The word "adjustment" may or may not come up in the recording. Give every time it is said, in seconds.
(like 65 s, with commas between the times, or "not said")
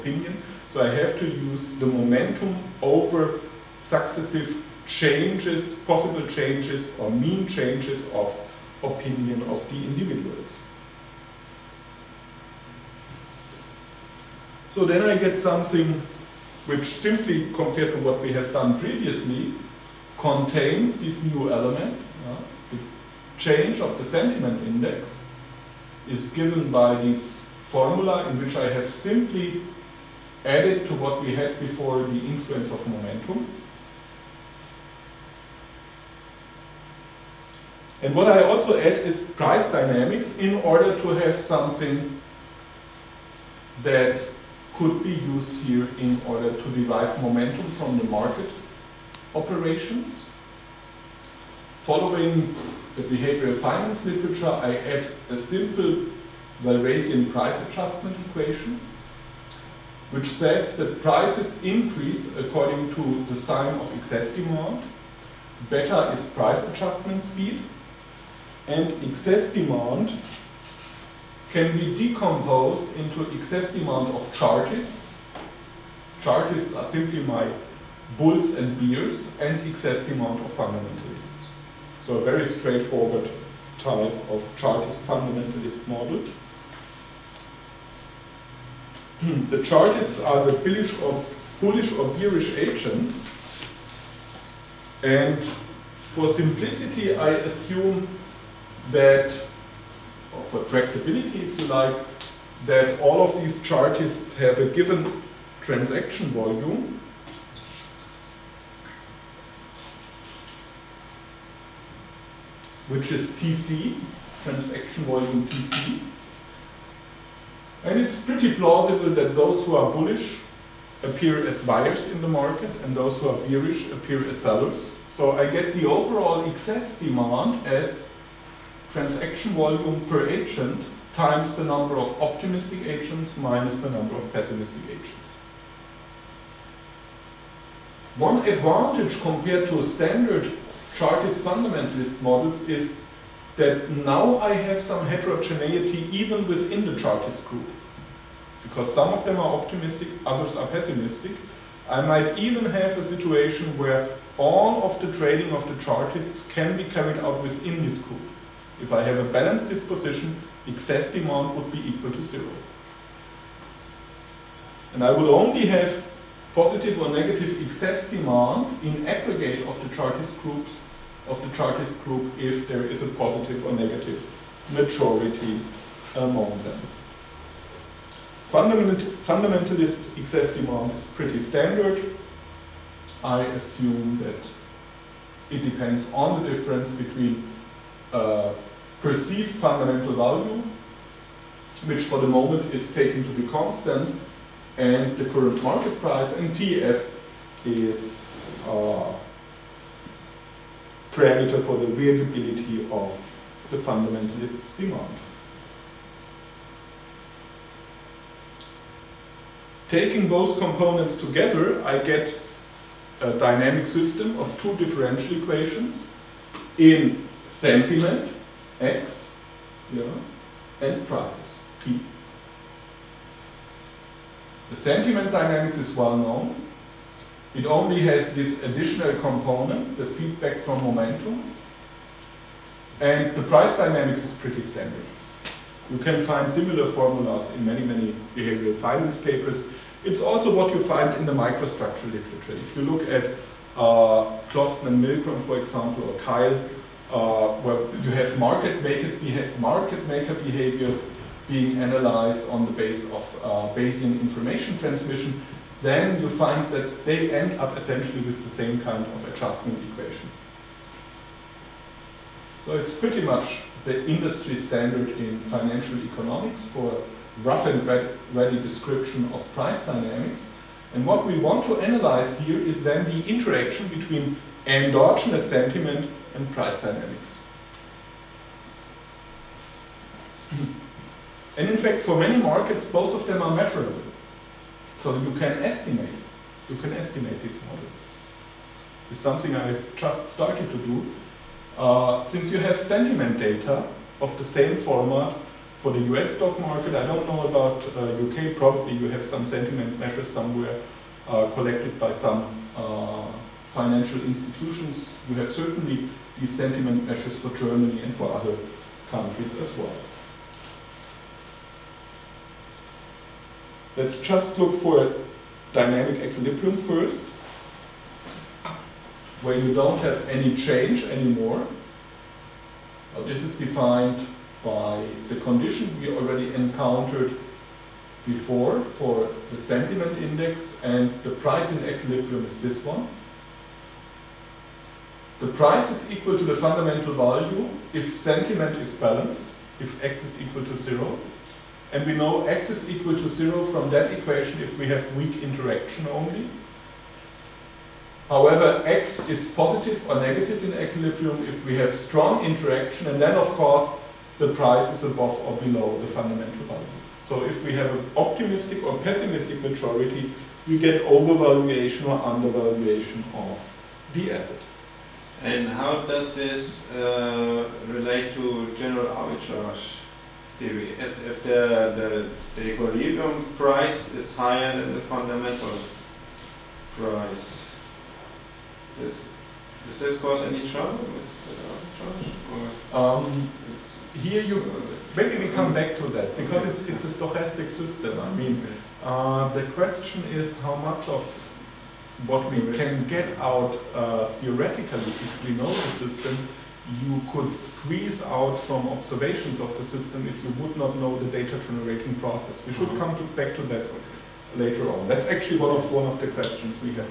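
57 s, 66 s, 259 s.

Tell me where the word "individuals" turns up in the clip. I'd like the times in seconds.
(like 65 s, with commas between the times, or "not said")
9 s.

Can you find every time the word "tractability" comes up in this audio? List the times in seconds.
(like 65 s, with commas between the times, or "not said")
100 s.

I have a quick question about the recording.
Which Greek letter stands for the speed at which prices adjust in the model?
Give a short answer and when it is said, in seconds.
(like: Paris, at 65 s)
Beta, at 65 s.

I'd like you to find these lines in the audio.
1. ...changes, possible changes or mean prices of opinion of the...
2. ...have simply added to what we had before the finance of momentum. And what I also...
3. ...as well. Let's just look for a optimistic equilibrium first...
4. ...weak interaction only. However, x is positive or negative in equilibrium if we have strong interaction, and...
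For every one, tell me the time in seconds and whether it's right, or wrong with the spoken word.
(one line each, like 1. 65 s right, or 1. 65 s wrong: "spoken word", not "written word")
1. 4 s wrong: "changes", not "prices"
2. 28 s wrong: "influence", not "finance"
3. 309 s wrong: "dynamic", not "optimistic"
4. 345 s right.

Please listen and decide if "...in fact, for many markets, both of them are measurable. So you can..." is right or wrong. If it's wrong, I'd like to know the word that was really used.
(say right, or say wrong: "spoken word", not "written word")
right.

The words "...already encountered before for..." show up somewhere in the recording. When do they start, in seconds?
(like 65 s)
326 s.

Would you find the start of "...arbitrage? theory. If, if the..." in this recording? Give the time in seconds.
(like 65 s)
369 s.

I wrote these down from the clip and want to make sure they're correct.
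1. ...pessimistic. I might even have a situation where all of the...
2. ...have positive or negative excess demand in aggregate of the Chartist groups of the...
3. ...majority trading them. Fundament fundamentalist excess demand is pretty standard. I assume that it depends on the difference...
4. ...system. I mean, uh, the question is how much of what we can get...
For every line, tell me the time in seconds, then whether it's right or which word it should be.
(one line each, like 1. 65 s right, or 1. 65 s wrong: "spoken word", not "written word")
1. 150 s right
2. 165 s right
3. 174 s wrong: "among", not "trading"
4. 387 s right.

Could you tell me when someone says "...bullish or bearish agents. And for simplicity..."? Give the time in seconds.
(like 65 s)
91 s.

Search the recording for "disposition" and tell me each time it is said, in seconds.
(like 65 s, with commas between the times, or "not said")
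159 s.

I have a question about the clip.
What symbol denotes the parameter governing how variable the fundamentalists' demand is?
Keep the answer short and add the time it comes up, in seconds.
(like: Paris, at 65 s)
TF, at 196 s.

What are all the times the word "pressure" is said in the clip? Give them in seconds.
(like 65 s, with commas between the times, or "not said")
not said.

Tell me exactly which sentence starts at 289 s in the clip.
It's something I have just started to do.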